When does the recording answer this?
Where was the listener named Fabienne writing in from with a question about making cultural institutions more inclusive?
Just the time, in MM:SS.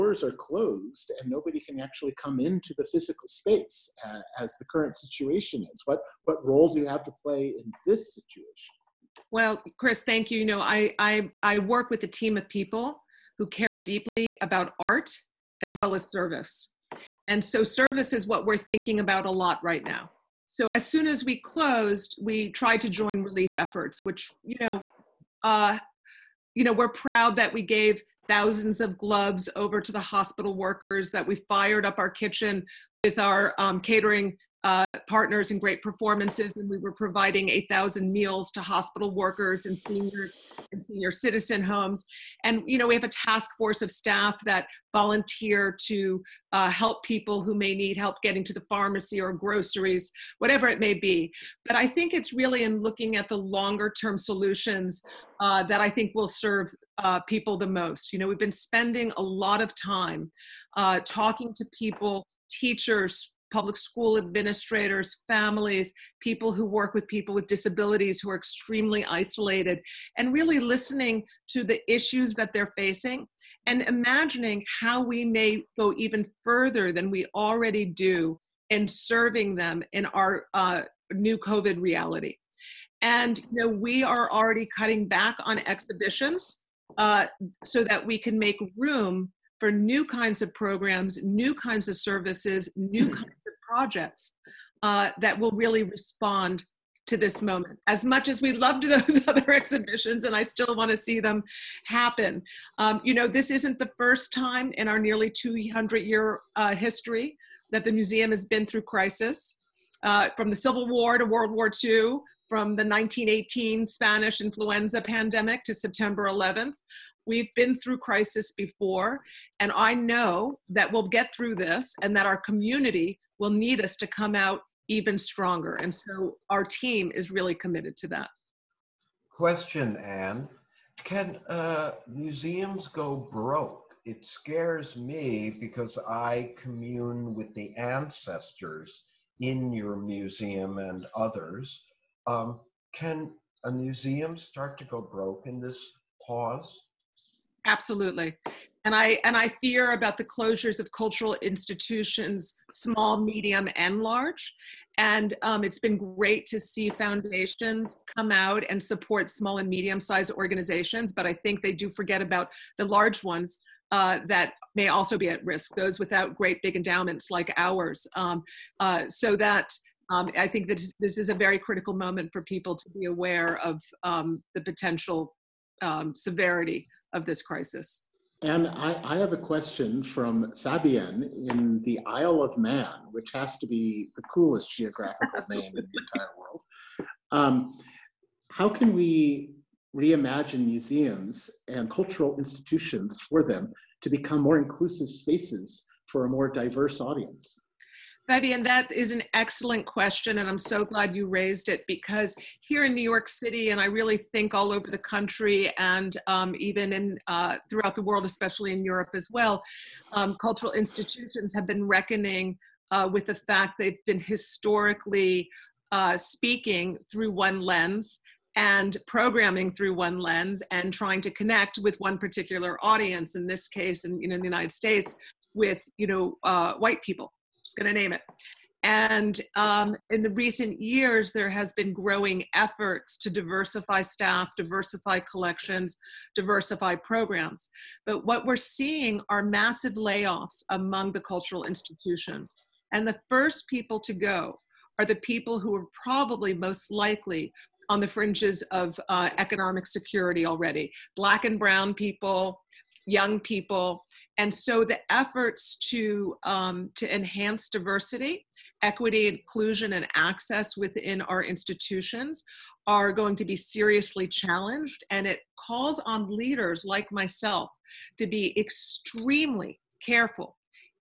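03:02.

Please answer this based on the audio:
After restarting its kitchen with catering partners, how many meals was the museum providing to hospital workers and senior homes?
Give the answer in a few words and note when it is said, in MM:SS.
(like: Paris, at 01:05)
8,000, at 00:37.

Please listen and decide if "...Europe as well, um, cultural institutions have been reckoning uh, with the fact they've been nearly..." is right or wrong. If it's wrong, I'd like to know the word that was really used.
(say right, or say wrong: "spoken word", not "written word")
wrong: "historically", not "nearly".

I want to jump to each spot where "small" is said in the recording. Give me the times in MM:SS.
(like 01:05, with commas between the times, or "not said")
02:32, 02:39.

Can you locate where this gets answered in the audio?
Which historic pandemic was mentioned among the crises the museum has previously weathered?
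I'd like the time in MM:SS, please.
01:52.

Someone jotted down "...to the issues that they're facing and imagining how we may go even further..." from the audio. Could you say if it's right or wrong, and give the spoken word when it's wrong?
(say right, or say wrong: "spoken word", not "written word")
right.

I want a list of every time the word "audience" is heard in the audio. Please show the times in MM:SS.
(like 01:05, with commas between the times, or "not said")
03:17, 03:42.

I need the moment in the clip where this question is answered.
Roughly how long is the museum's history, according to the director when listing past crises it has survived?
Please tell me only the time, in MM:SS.
01:44.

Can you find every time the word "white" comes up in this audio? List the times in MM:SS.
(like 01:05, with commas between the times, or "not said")
03:46.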